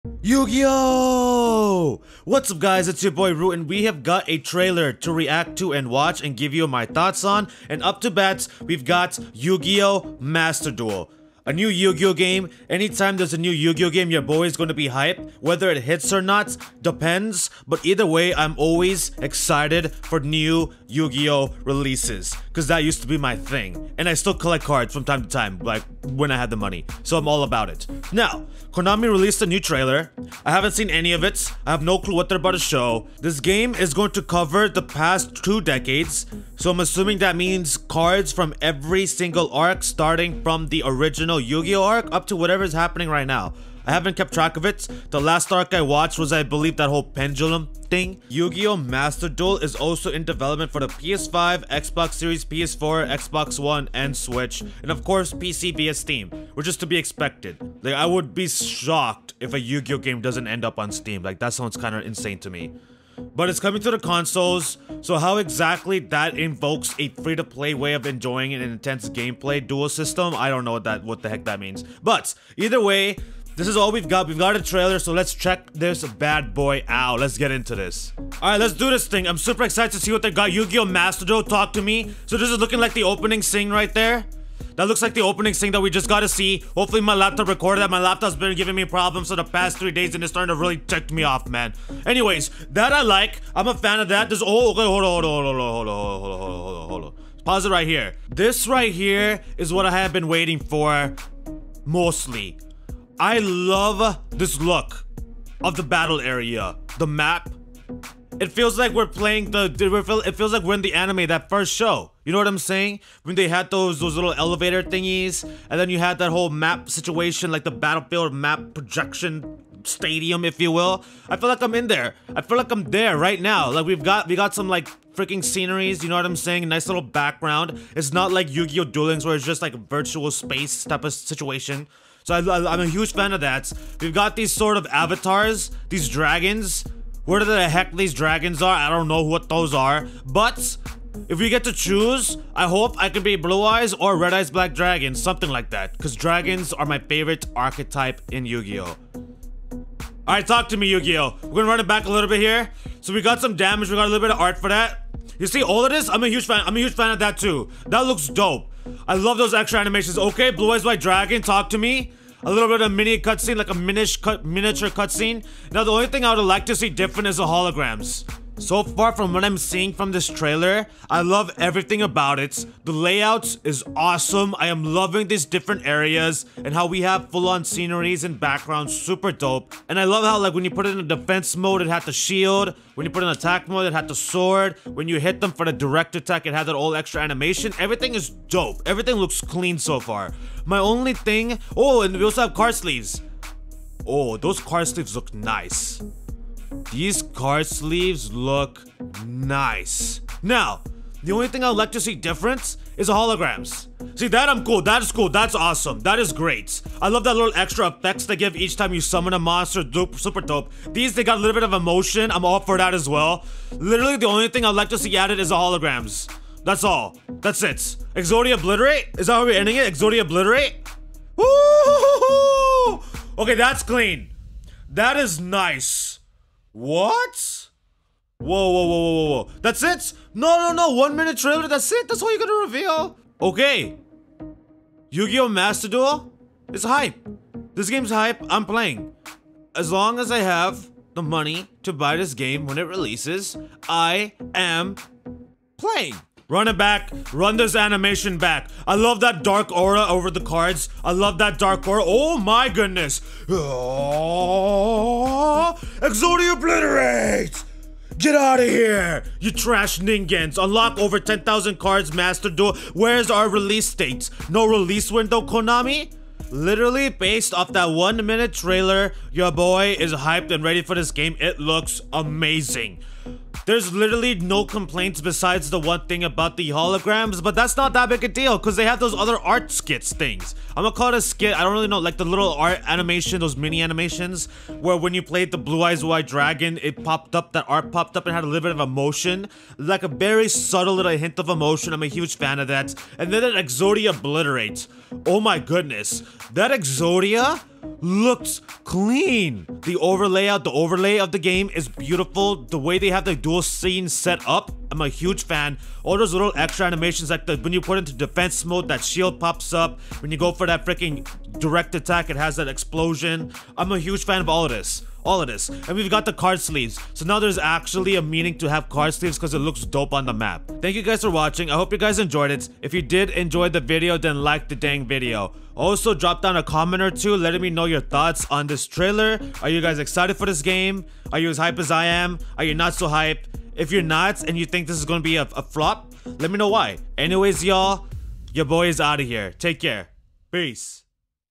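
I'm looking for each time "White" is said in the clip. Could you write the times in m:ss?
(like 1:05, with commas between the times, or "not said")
2:40, 4:46.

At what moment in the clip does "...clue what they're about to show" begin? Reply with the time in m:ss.
0:31.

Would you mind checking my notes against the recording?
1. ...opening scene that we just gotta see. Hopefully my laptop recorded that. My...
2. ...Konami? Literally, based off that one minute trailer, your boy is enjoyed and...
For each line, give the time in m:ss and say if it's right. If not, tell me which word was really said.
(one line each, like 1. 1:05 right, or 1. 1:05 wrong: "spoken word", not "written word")
1. 1:25 right
2. 4:25 wrong: "hyped", not "enjoyed".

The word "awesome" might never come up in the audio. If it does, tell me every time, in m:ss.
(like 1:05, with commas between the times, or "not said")
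2:53, 3:25.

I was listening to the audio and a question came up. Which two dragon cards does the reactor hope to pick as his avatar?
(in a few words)
Blue Eyes or Red Eyes Black Dragon.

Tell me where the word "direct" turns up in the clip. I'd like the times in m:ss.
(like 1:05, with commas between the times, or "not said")
3:05, 5:11.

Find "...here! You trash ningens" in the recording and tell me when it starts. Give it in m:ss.
4:18.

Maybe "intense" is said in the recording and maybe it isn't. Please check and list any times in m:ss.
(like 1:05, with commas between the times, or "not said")
1:08.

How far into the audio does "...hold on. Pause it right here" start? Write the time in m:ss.
1:36.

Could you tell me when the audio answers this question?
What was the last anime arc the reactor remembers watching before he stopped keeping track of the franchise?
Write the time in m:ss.
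0:47.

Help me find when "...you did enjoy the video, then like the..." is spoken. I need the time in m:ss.
5:22.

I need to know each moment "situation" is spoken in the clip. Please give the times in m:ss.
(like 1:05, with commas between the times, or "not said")
1:56, 2:11.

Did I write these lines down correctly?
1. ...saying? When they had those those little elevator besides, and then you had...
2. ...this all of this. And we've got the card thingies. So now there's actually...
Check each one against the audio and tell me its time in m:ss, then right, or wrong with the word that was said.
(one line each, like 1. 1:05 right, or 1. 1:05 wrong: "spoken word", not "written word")
1. 1:52 wrong: "thingies", not "besides"
2. 5:14 wrong: "sleeves", not "thingies".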